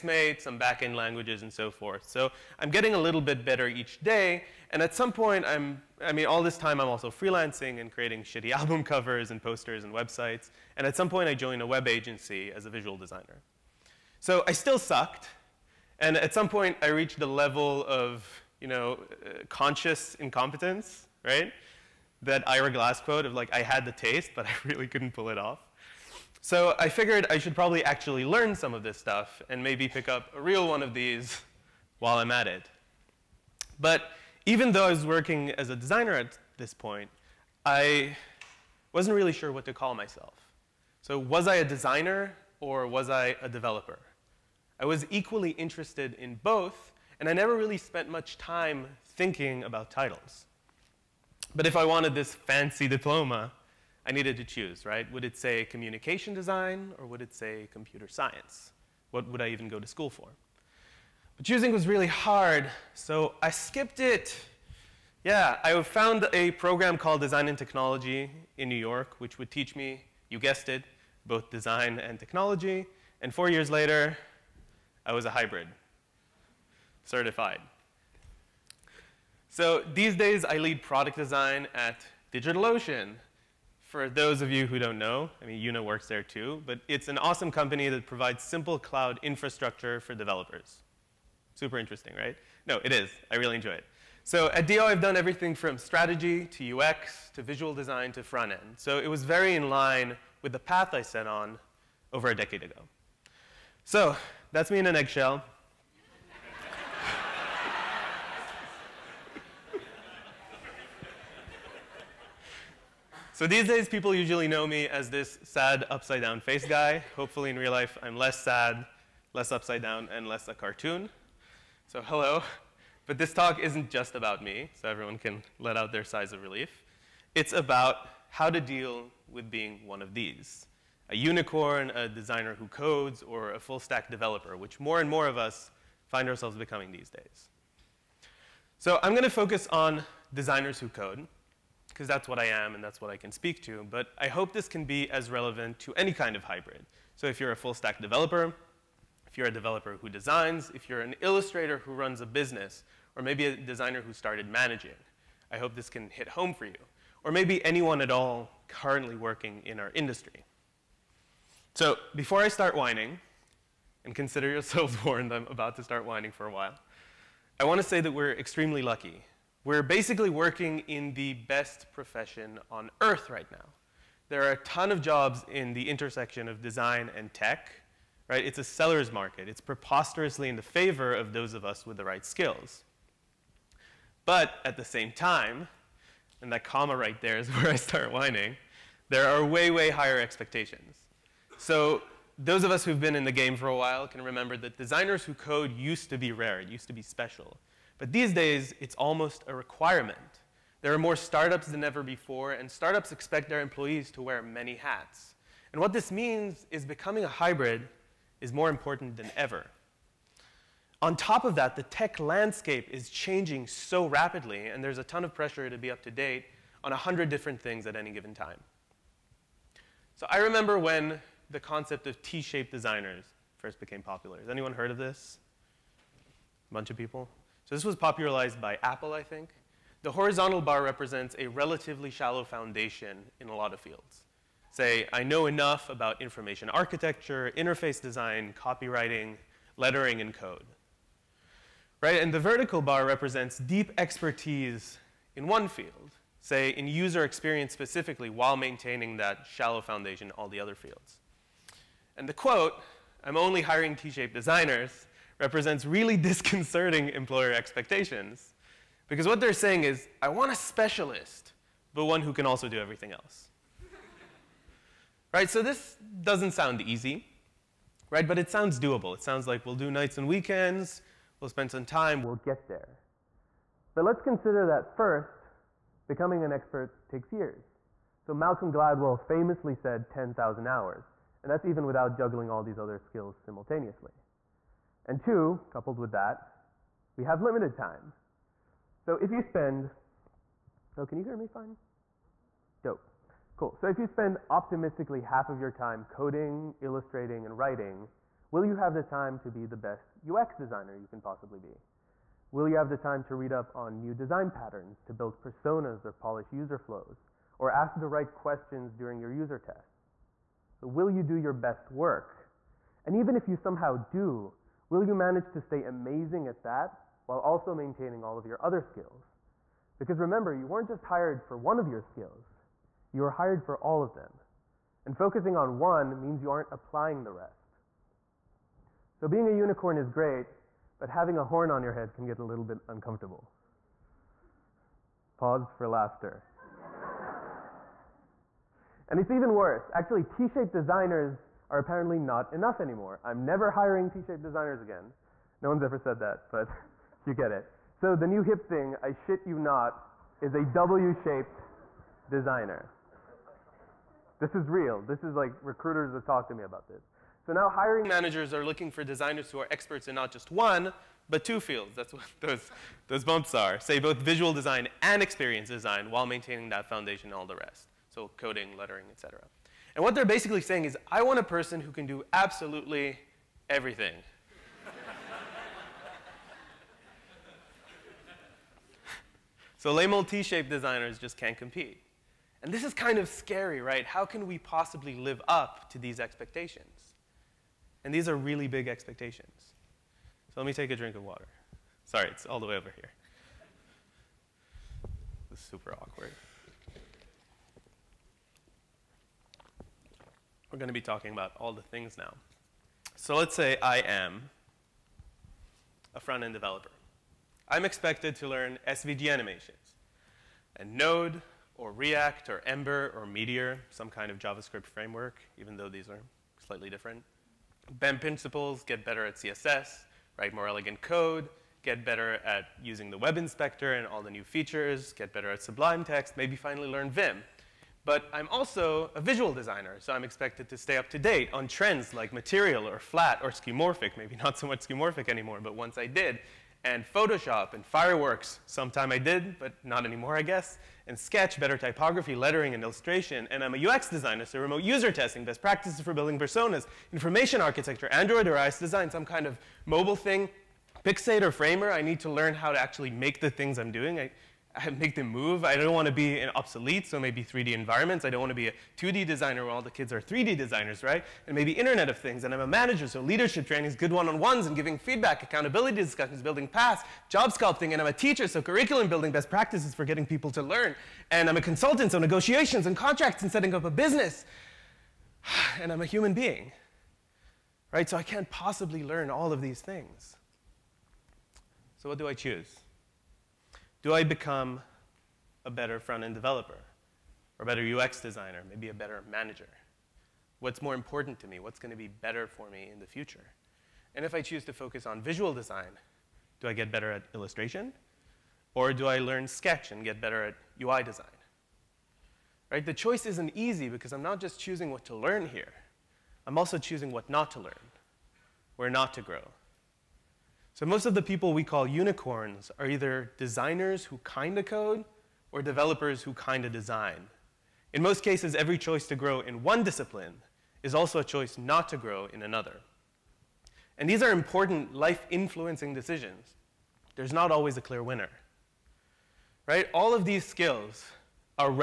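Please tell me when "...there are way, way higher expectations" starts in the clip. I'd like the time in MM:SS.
03:09.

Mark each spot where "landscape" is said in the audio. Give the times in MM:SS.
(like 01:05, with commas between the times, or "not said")
03:32.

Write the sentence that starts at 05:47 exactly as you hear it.
So the new hip thing, I shit you not, is a W-shaped designer.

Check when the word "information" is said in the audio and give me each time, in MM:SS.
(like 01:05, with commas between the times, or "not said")
03:56, 07:27.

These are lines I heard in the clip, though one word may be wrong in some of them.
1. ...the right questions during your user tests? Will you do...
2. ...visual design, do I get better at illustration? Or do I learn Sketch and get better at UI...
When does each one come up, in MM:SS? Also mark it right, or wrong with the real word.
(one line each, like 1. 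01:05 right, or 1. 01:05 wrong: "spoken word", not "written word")
1. 05:07 right
2. 08:15 right.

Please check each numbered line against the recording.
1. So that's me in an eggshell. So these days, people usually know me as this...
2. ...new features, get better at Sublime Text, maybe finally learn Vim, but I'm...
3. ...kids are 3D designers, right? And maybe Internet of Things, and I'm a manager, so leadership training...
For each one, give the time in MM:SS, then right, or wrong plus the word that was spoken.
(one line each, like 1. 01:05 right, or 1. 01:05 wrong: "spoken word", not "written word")
1. 01:43 right
2. 07:04 right
3. 07:39 right.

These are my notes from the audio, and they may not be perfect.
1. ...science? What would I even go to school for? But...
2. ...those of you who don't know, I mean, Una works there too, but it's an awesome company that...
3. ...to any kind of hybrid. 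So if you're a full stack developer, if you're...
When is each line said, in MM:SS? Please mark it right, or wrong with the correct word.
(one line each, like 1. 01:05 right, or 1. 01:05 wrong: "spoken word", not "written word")
1. 00:58 right
2. 01:24 right
3. 02:25 right.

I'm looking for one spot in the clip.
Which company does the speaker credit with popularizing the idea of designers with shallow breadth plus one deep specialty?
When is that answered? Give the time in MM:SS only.
03:48.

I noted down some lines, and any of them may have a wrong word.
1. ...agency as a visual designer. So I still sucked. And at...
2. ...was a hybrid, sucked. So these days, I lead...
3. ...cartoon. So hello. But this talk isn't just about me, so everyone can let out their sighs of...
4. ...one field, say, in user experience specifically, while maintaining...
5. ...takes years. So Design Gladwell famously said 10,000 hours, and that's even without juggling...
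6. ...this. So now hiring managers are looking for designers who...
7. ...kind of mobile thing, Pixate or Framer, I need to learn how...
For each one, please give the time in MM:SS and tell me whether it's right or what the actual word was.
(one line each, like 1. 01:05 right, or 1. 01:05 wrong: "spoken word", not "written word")
1. 00:11 right
2. 01:15 wrong: "certified", not "sucked"
3. 02:00 right
4. 04:05 right
5. 04:37 wrong: "Malcolm", not "Design"
6. 05:56 right
7. 07:29 right.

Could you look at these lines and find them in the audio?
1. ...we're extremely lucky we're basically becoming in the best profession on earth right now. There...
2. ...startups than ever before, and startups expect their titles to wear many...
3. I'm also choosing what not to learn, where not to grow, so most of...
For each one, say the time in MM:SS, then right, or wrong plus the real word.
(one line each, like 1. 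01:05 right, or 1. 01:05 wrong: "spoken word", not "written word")
1. 02:48 wrong: "working", not "becoming"
2. 03:21 wrong: "employees", not "titles"
3. 08:26 right.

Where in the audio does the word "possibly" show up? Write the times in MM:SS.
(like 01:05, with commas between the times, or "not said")
05:01, 06:24, 07:58.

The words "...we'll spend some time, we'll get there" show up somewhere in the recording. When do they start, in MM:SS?
04:31.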